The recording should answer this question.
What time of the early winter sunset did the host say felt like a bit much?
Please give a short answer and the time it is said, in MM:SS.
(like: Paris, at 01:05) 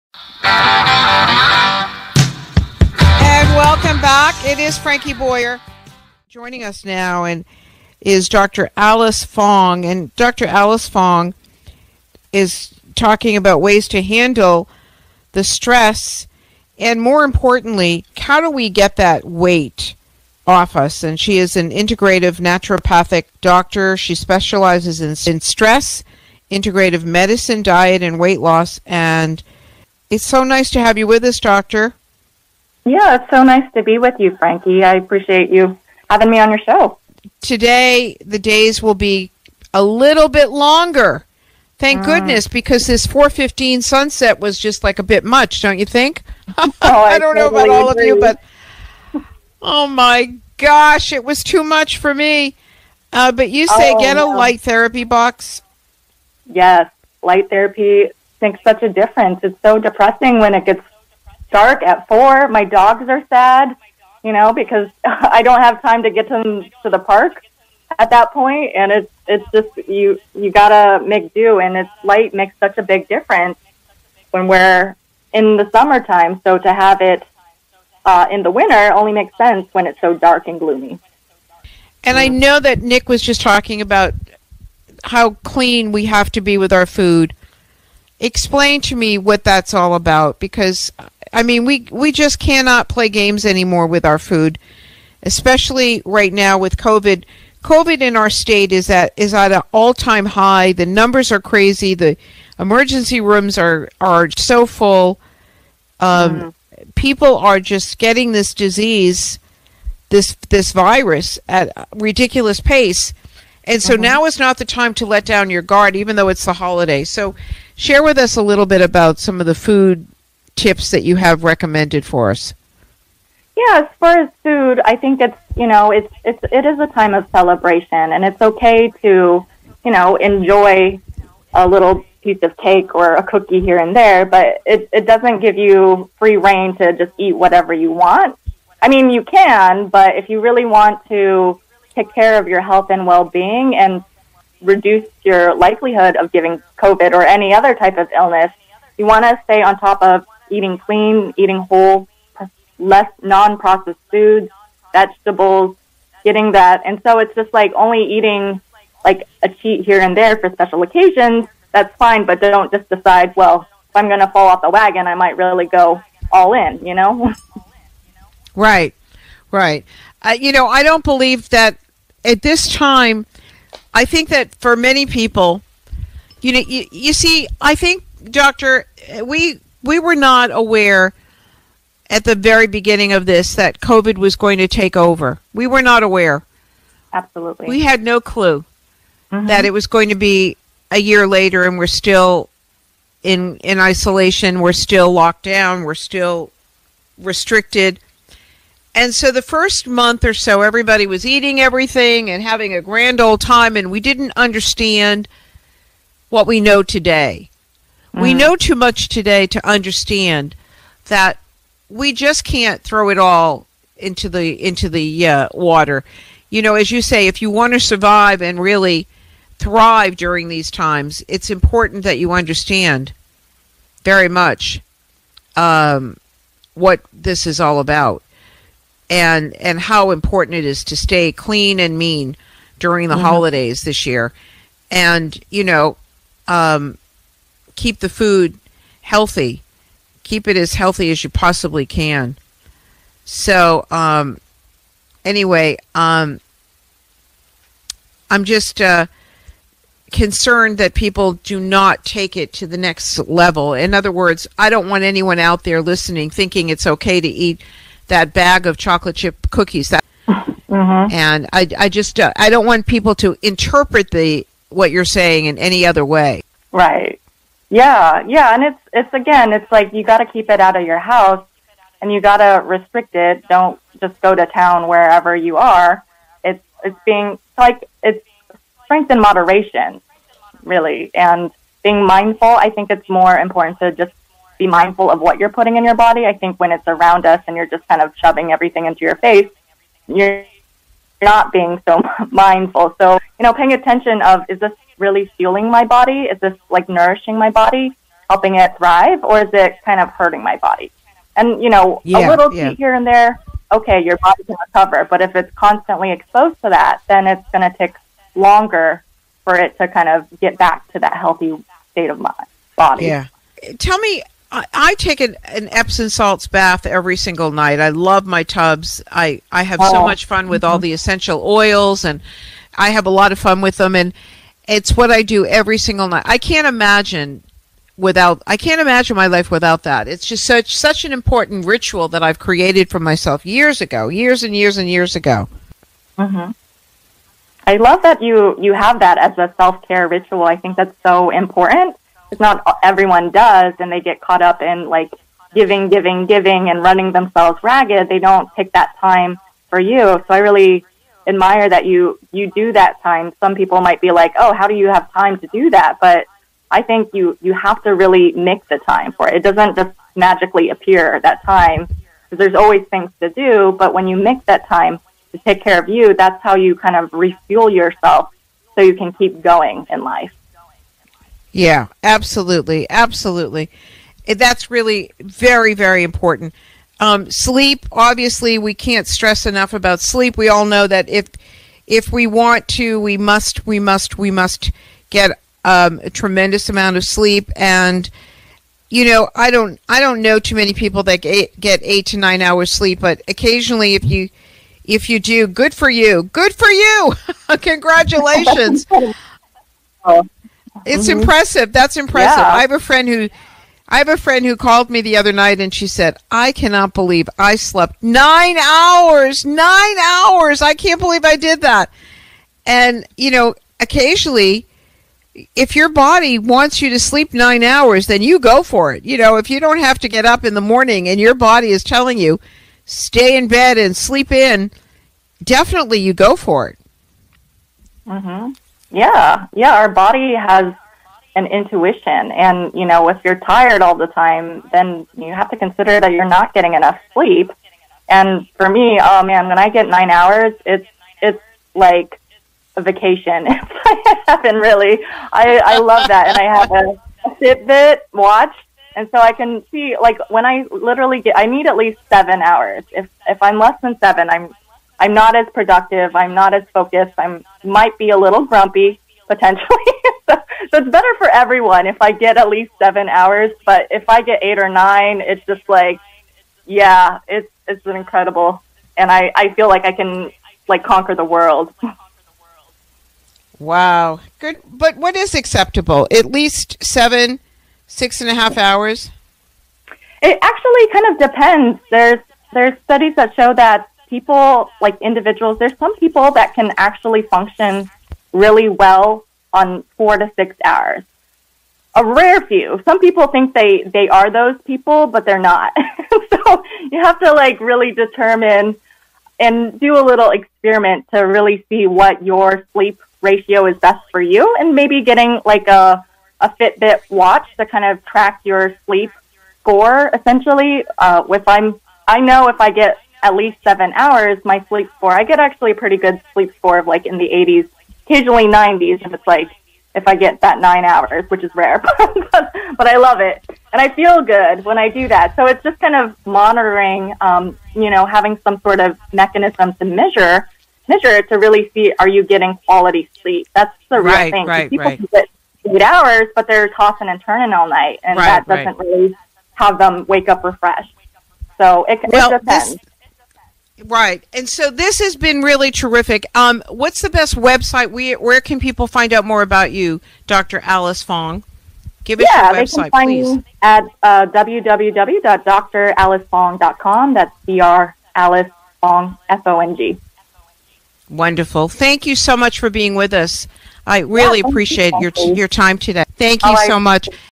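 4:15, at 00:43.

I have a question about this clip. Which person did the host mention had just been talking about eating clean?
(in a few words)
Nick.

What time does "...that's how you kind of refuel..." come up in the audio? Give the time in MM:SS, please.
06:06.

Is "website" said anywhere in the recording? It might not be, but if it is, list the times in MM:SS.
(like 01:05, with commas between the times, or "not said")
09:07, 09:12.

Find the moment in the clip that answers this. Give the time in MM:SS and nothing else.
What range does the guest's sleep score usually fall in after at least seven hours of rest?
08:37.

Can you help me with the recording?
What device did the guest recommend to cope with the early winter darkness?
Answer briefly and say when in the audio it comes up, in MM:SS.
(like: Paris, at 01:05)
light therapy box, at 00:54.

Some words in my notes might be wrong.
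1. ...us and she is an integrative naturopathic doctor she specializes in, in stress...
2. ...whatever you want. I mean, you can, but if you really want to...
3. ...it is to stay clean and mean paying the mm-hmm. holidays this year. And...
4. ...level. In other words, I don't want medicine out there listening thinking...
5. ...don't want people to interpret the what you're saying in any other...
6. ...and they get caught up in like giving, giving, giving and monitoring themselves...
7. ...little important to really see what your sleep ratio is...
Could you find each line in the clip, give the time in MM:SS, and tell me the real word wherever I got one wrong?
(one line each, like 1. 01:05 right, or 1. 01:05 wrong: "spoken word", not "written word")
1. 00:20 right
2. 02:17 right
3. 03:50 wrong: "during", not "paying"
4. 04:13 wrong: "anyone", not "medicine"
5. 04:22 right
6. 05:43 wrong: "running", not "monitoring"
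7. 08:20 wrong: "experiment", not "important".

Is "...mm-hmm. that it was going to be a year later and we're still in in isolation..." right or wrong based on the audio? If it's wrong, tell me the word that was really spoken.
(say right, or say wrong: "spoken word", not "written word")
right.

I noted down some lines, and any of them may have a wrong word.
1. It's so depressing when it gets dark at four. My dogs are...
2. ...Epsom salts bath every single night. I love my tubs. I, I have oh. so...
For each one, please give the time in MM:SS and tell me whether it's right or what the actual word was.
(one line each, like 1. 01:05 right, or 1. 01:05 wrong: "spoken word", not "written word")
1. 00:59 right
2. 05:15 right.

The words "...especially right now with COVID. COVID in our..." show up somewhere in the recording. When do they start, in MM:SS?
01:35.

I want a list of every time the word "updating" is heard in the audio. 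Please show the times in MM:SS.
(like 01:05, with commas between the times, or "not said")
not said.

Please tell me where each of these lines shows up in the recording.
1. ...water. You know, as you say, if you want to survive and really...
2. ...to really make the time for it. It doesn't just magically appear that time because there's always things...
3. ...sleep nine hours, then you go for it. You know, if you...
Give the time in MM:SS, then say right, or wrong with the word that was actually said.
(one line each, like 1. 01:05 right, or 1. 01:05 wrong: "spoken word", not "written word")
1. 03:35 right
2. 05:57 right
3. 06:57 right.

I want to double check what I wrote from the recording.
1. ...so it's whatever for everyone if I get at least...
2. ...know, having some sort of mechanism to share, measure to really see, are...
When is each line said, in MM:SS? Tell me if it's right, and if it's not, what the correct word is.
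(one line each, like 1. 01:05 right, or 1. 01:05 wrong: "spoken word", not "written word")
1. 07:40 wrong: "better", not "whatever"
2. 08:47 wrong: "measure", not "share".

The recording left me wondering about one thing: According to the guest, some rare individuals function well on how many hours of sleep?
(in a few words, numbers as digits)
4 to 6 hours.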